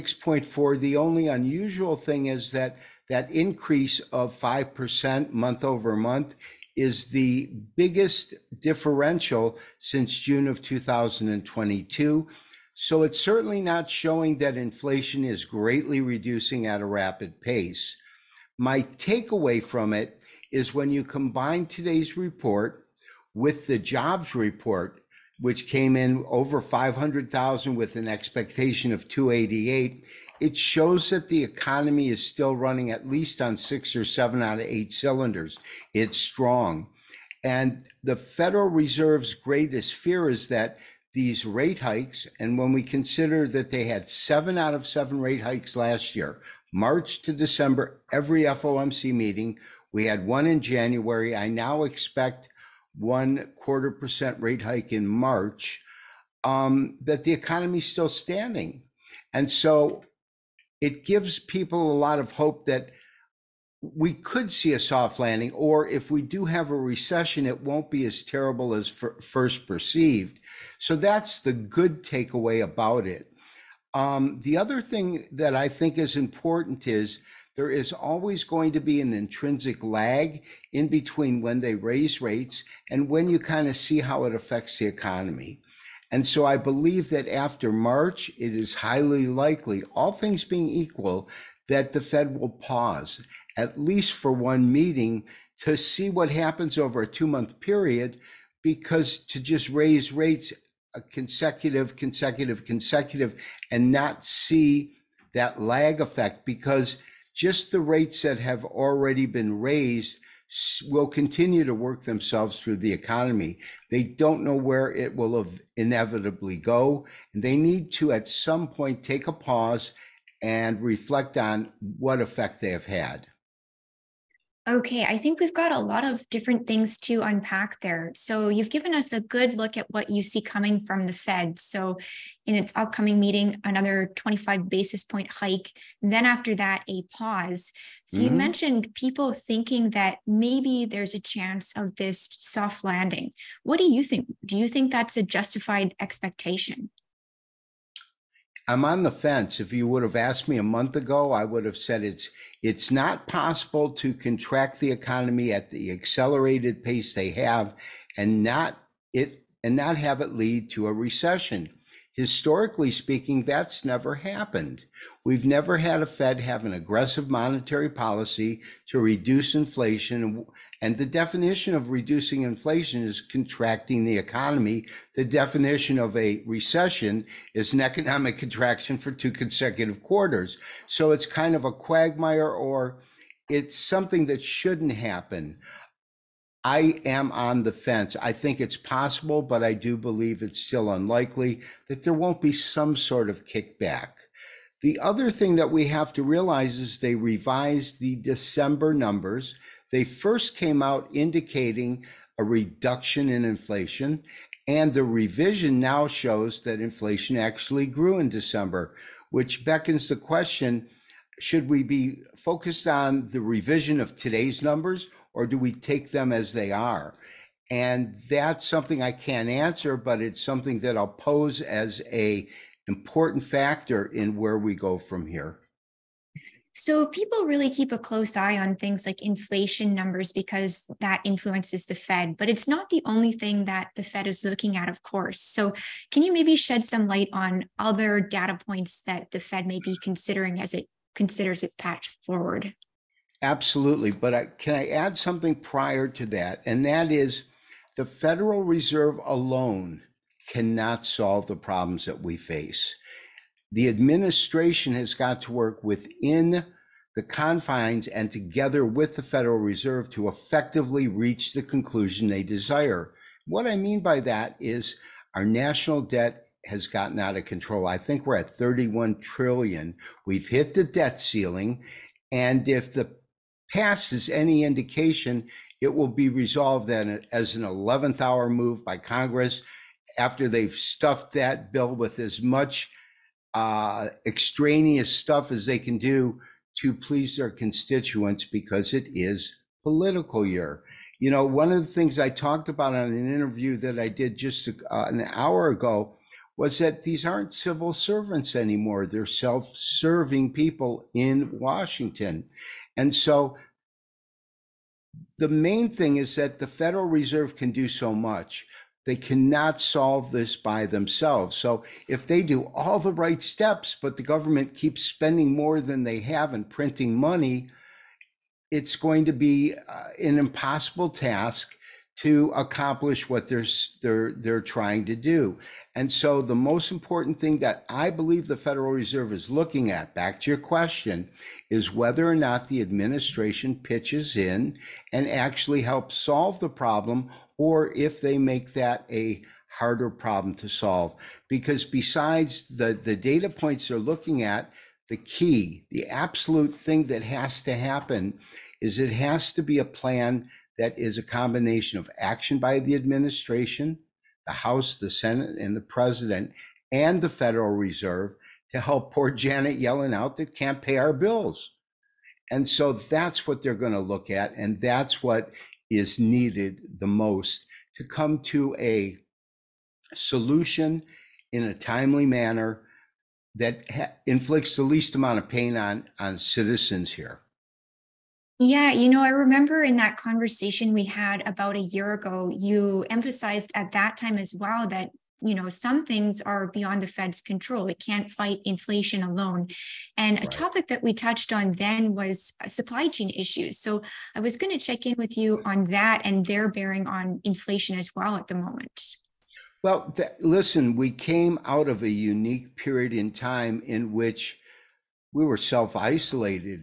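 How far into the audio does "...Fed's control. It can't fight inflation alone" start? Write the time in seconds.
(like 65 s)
387 s.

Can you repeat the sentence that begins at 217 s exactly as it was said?
And that's something I can't answer, but it's something that I'll pose as a important factor in where we go from here.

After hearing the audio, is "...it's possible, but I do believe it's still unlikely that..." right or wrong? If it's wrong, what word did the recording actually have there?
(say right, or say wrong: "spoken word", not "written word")
right.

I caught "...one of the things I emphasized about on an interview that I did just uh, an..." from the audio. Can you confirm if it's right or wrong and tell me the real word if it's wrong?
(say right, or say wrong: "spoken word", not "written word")
wrong: "talked", not "emphasized".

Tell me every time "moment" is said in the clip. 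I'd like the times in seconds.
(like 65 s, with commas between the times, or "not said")
398 s.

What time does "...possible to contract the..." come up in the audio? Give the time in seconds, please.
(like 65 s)
153 s.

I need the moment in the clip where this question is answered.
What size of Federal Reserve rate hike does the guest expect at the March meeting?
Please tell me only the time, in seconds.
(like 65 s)
52 s.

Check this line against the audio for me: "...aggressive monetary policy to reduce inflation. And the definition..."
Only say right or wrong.
right.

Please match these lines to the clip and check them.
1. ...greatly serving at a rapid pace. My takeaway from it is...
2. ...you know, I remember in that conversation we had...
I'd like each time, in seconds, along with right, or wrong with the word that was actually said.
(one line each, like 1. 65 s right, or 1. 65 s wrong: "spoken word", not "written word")
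1. 15 s wrong: "reducing", not "serving"
2. 378 s right.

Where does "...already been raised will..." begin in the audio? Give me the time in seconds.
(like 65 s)
108 s.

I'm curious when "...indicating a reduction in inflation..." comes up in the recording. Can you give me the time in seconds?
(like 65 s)
201 s.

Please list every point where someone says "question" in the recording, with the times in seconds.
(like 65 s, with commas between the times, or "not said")
210 s, 330 s.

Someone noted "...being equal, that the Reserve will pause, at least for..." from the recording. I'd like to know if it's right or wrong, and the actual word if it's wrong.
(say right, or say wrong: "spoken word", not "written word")
wrong: "Fed", not "Reserve".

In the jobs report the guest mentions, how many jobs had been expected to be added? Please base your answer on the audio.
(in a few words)
288.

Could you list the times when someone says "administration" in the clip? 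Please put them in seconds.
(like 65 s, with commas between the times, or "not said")
253 s, 332 s, 352 s.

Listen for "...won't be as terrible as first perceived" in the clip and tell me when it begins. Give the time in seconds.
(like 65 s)
67 s.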